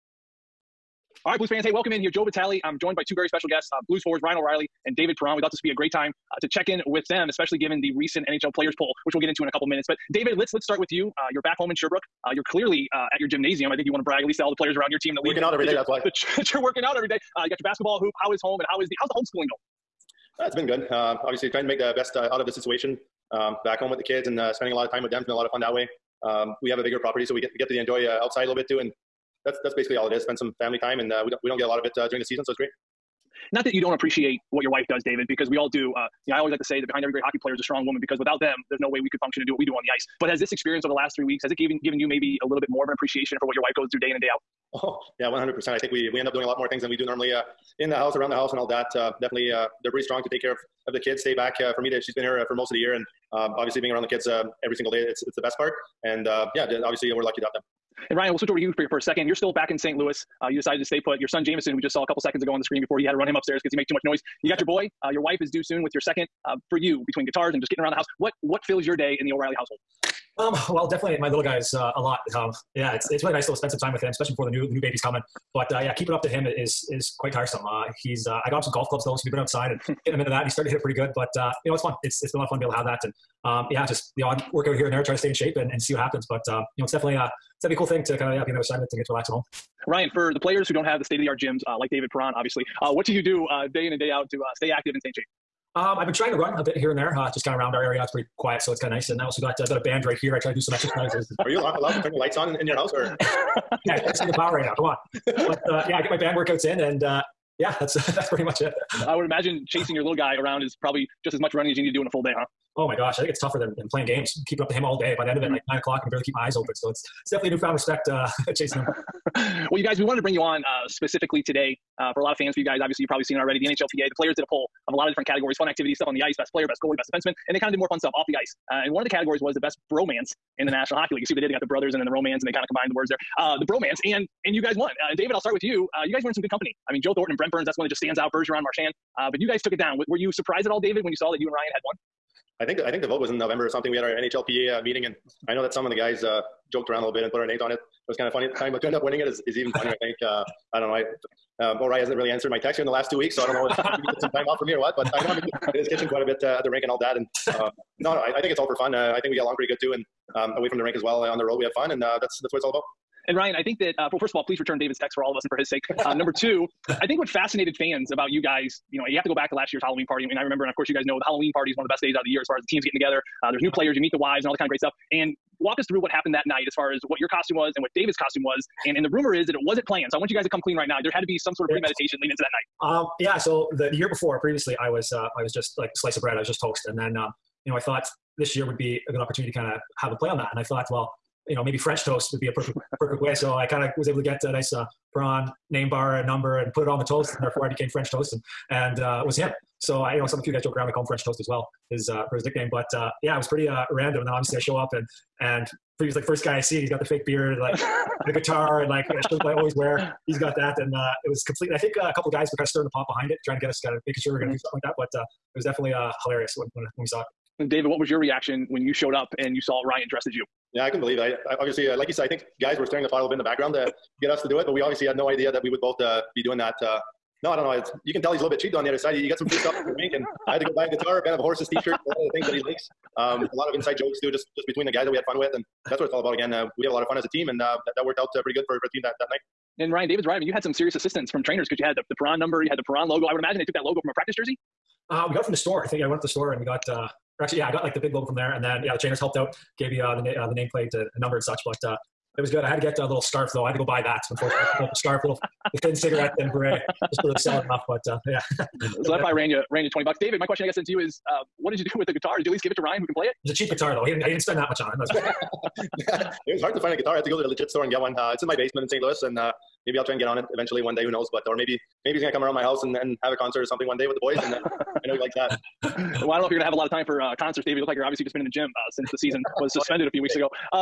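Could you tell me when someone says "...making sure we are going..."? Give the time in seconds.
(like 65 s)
214 s.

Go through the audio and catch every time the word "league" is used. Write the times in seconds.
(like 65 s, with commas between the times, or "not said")
15 s, 131 s.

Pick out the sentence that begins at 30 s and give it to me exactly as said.
Spend some family time, and uh, we don't we don't get a lot of it uh, during the season, so it's great.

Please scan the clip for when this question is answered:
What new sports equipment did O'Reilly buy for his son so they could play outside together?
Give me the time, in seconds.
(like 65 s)
78 s.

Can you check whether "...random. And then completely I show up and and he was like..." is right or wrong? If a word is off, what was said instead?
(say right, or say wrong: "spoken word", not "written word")
wrong: "obviously", not "completely".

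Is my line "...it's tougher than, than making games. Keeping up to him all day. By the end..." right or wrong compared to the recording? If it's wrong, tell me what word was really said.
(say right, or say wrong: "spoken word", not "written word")
wrong: "playing", not "making".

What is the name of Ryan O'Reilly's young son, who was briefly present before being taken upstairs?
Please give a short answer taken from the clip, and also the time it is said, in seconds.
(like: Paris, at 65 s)
Jamison, at 61 s.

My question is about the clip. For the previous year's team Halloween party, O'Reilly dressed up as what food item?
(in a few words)
Slice of bread.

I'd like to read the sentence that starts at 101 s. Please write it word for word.
Are you allowed to turn the lights on in, in your house, or?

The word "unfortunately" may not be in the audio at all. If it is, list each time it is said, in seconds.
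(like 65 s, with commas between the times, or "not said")
254 s.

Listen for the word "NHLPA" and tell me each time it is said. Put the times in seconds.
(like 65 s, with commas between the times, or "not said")
123 s, 144 s.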